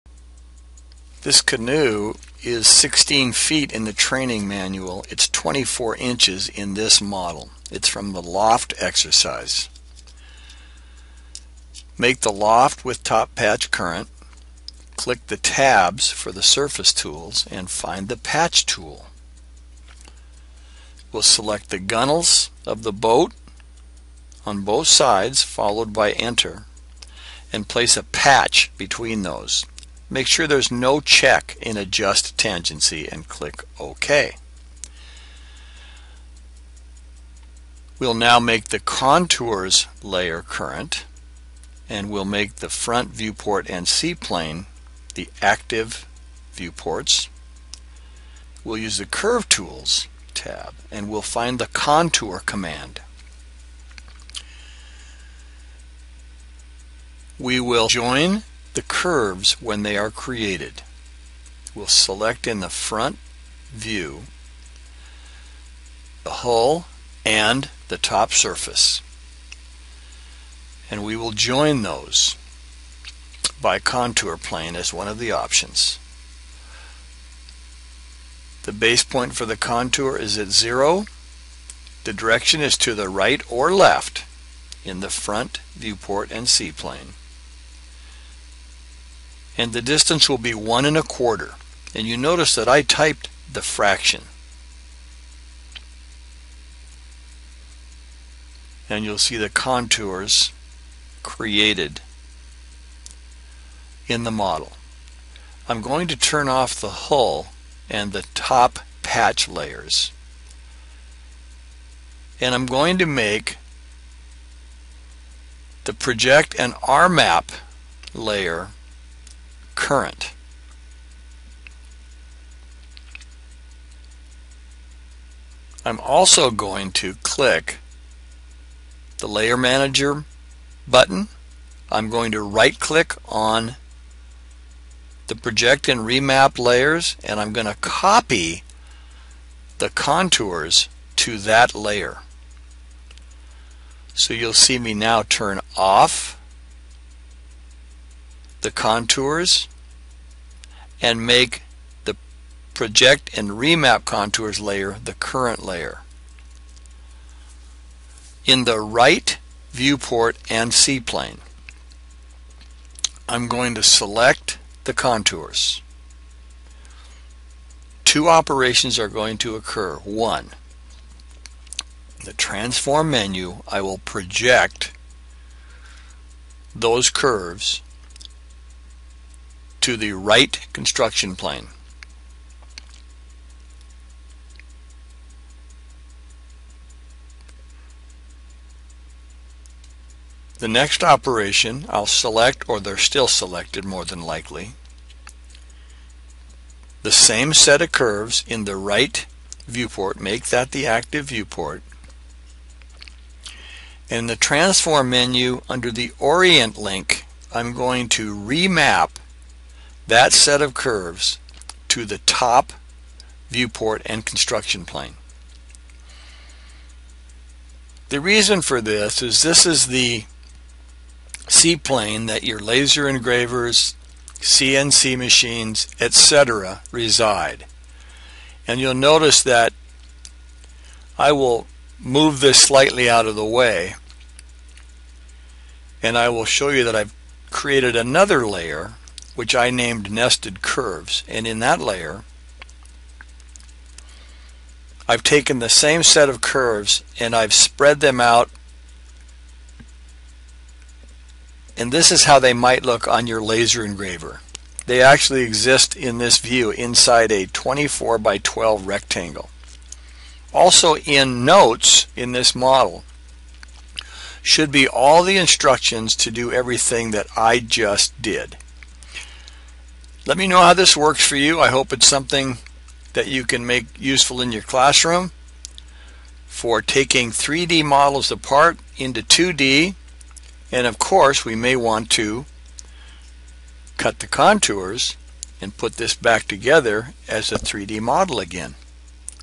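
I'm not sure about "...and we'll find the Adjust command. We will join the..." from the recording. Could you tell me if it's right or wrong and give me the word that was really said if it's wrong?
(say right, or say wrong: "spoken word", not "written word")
wrong: "Contour", not "Adjust".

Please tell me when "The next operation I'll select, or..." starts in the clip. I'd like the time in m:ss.
3:10.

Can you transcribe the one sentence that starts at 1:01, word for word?
We'll select in the front view the hull and the top surface.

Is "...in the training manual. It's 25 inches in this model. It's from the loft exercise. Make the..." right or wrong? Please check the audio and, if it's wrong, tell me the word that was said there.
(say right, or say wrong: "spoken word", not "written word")
wrong: "24", not "25".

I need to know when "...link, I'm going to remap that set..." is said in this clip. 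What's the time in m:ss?
3:26.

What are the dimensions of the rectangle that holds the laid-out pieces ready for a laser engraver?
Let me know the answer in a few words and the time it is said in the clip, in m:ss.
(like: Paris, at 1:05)
24 by 12, at 4:17.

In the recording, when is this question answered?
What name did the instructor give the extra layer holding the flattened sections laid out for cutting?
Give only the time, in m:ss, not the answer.
4:00.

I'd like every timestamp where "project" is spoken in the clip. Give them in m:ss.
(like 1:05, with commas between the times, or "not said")
1:55, 2:15, 2:32, 2:53.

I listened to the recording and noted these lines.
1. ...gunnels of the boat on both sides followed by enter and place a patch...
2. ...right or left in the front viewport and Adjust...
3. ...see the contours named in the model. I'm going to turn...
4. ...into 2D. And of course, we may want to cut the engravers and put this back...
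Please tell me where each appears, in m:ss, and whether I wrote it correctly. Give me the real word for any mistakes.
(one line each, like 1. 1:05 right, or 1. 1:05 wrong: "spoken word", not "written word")
1. 0:21 right
2. 1:23 wrong: "CPlane", not "Adjust"
3. 1:39 wrong: "created", not "named"
4. 4:38 wrong: "contours", not "engravers".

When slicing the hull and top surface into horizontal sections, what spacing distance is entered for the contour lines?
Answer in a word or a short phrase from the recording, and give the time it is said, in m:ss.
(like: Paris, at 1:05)
1 1/4, at 1:30.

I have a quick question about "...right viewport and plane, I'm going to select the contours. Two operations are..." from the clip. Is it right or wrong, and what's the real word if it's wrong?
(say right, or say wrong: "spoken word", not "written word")
right.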